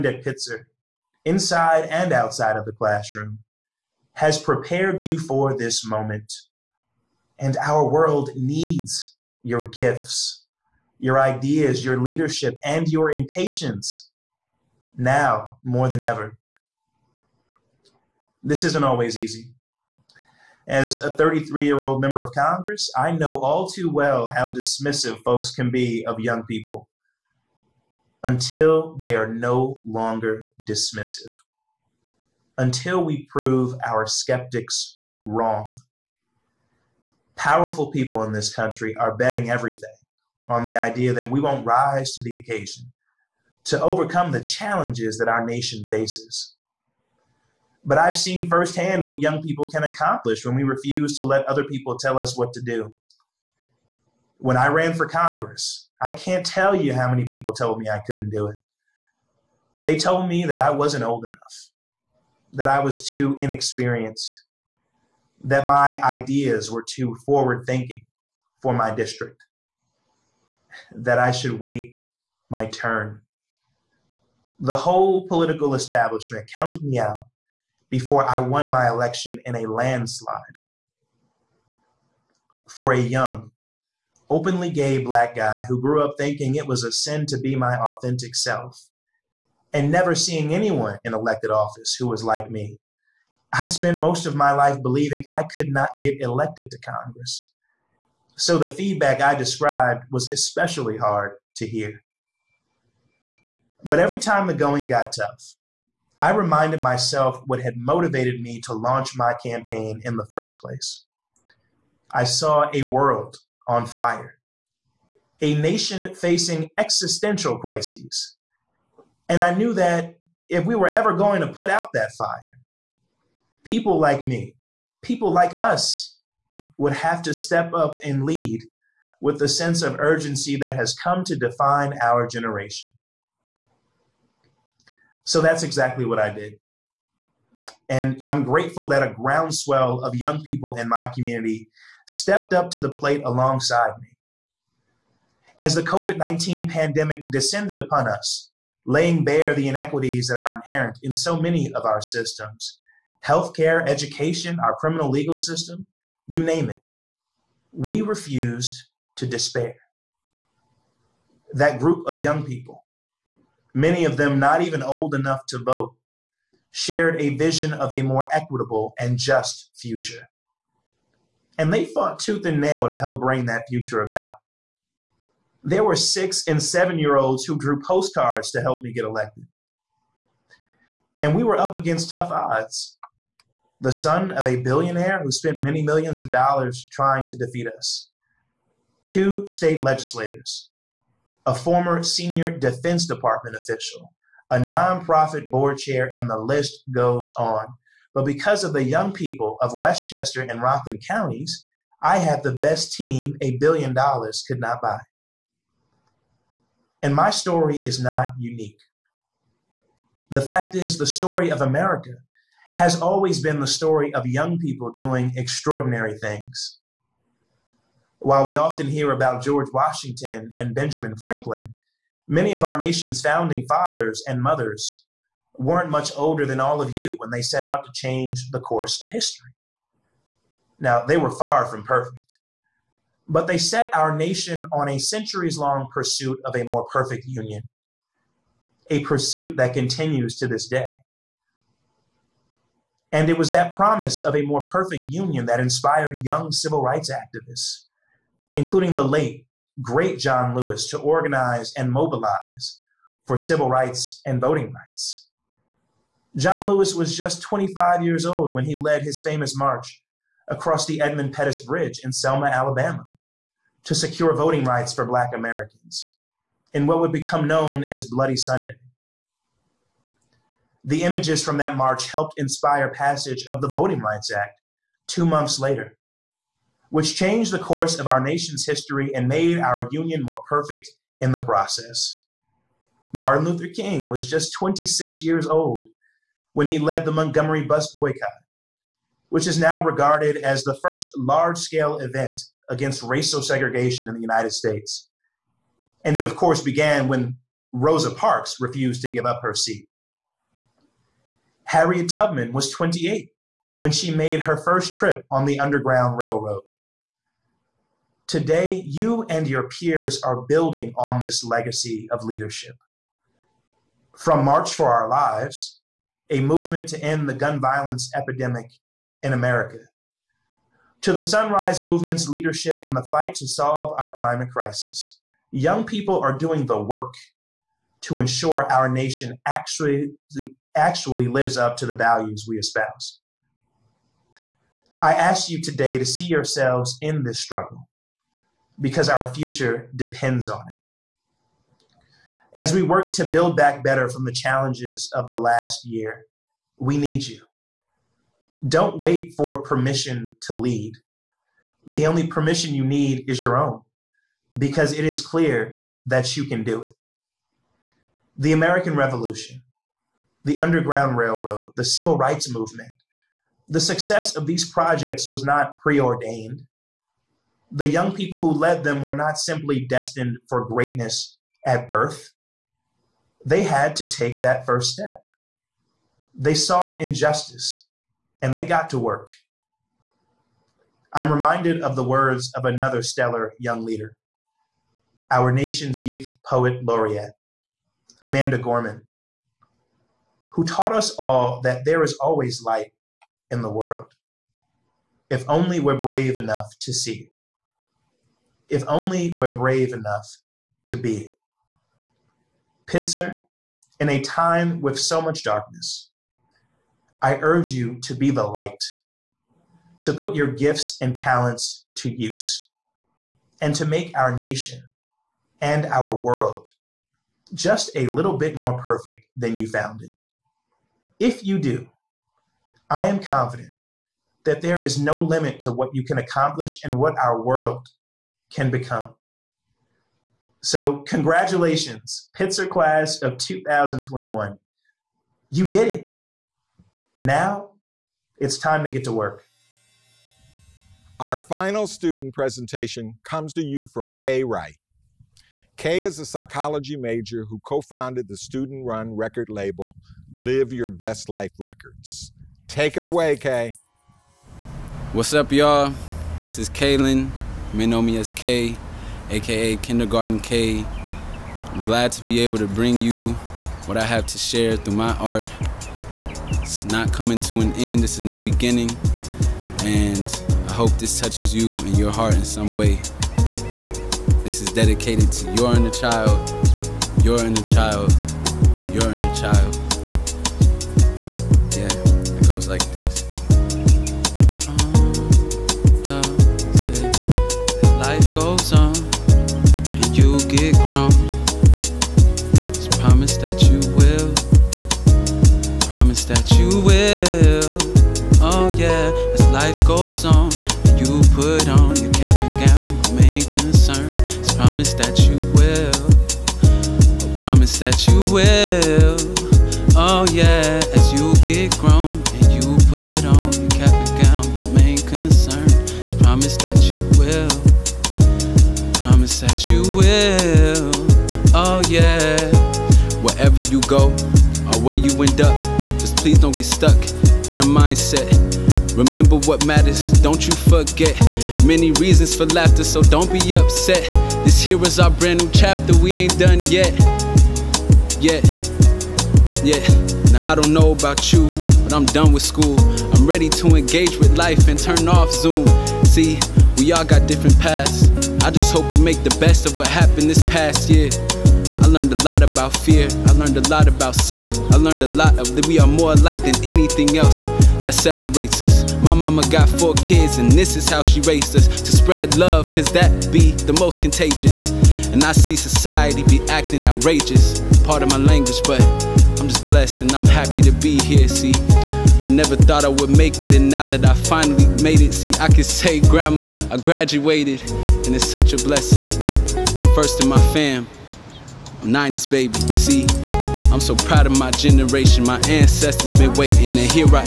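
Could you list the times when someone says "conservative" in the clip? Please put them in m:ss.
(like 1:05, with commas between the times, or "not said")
not said.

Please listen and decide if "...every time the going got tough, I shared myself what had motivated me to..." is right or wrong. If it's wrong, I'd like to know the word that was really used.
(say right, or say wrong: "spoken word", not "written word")
wrong: "reminded", not "shared".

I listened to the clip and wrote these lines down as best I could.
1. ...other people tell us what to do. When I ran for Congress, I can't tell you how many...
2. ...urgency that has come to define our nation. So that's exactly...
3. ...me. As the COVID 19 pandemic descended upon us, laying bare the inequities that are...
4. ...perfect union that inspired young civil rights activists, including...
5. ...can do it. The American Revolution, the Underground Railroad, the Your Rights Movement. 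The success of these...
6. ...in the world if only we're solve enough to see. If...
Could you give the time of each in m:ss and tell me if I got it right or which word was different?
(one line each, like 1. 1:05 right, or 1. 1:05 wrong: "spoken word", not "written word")
1. 0:51 right
2. 2:09 wrong: "generation", not "nation"
3. 2:23 right
4. 4:04 right
5. 5:56 wrong: "Civil", not "Your"
6. 6:33 wrong: "brave", not "solve".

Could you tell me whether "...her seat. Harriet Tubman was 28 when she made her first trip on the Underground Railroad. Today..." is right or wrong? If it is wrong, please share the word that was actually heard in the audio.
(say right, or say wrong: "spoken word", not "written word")
right.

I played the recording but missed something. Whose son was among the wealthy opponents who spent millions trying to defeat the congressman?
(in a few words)
A billionaire.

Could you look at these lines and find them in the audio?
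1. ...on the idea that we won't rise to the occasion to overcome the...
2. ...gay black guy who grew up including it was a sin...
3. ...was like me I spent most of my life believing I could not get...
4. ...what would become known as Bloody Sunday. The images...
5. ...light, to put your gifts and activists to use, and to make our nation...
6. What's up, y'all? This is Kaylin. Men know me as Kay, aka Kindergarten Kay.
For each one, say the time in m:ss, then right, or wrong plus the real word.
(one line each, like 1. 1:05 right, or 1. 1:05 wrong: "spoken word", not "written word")
1. 0:40 right
2. 1:24 wrong: "thinking", not "including"
3. 1:32 right
4. 4:26 right
5. 6:48 wrong: "talents", not "activists"
6. 7:35 right.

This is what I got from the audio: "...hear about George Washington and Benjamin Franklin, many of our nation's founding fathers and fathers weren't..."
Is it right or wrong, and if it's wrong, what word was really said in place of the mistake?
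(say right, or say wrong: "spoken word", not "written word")
wrong: "mothers", not "fathers".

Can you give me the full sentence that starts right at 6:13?
They had to take that first step.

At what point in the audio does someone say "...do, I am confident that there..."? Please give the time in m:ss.
7:01.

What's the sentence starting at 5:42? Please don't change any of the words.
As we work to build back better from the challenges of the last year, we need you.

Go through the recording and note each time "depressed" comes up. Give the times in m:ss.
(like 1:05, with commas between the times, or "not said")
not said.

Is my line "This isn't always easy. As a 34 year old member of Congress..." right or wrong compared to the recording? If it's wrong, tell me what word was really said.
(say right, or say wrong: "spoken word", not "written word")
wrong: "33", not "34".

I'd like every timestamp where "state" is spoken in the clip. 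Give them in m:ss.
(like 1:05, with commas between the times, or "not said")
3:09, 4:54.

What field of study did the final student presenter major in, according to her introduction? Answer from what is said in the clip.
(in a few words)
Psychology.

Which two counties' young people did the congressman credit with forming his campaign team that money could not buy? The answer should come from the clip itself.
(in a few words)
Westchester and Rockland.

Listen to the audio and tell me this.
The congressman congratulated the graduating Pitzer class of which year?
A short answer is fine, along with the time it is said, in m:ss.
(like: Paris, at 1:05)
2021, at 7:13.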